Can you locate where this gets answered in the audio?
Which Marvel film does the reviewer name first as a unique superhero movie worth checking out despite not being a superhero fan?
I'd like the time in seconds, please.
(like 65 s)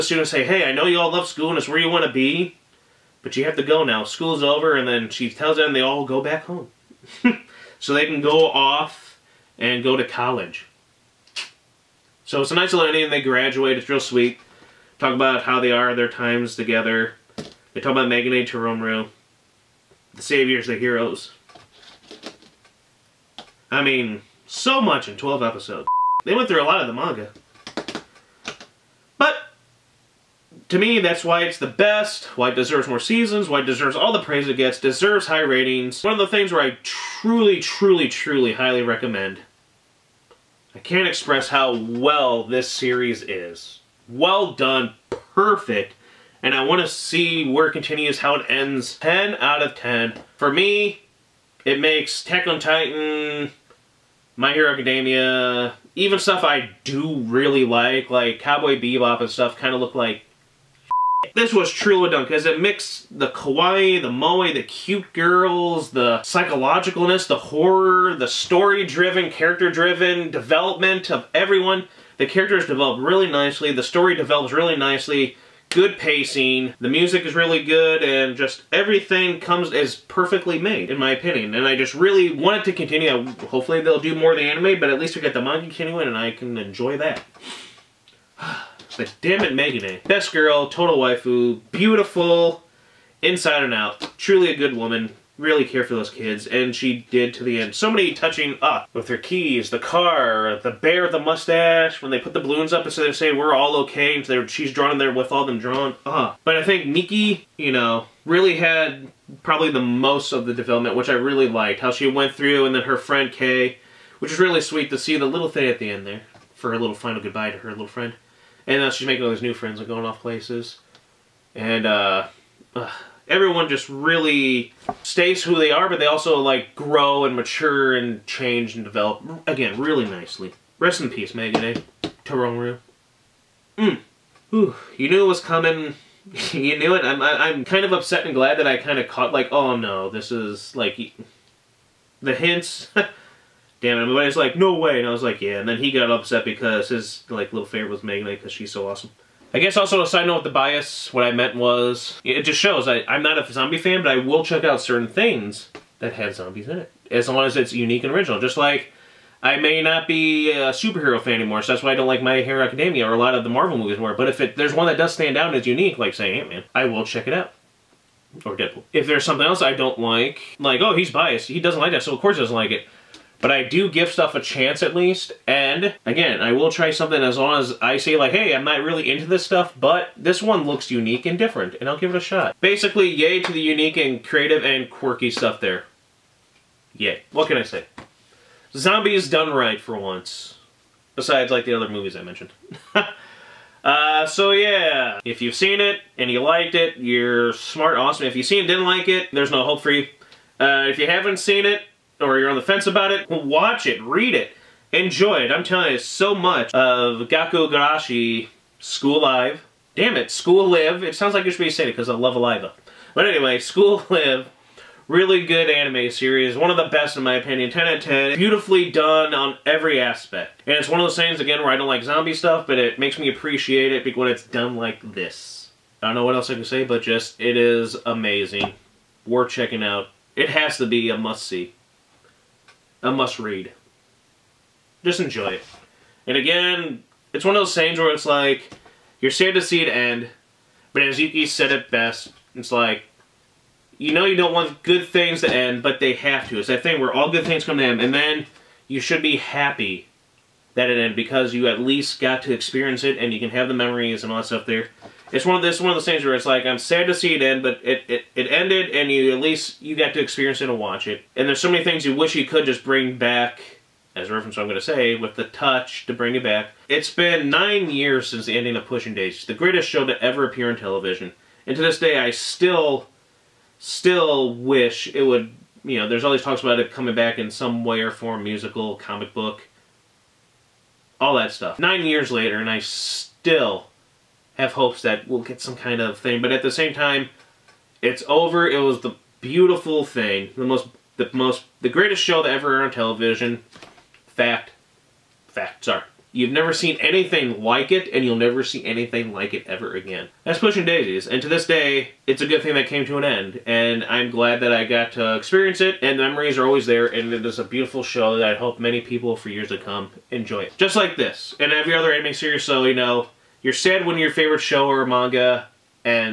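166 s.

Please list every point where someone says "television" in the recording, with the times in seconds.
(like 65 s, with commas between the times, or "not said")
270 s, 292 s.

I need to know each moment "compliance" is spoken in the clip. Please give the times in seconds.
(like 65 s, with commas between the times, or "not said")
not said.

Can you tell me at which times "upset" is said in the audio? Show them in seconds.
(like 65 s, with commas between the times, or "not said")
137 s, 146 s.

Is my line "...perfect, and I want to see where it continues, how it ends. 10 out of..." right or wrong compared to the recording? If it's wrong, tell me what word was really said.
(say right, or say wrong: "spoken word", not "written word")
right.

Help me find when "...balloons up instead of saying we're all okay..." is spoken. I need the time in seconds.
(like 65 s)
102 s.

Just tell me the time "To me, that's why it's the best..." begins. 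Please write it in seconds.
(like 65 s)
30 s.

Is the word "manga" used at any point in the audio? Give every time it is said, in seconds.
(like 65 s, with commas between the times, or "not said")
26 s, 85 s, 315 s.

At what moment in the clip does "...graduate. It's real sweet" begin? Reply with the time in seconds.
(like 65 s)
13 s.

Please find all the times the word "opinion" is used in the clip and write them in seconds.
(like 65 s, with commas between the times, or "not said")
81 s, 217 s.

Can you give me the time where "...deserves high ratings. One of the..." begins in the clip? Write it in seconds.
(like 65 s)
34 s.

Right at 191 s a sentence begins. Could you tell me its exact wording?
Besides, like, the other movies I mentioned.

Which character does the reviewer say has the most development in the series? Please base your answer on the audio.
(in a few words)
Miki.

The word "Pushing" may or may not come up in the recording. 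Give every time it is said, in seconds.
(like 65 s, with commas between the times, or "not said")
268 s, 300 s.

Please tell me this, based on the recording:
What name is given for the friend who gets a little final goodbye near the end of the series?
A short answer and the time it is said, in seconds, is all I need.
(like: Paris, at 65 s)
Kay, at 113 s.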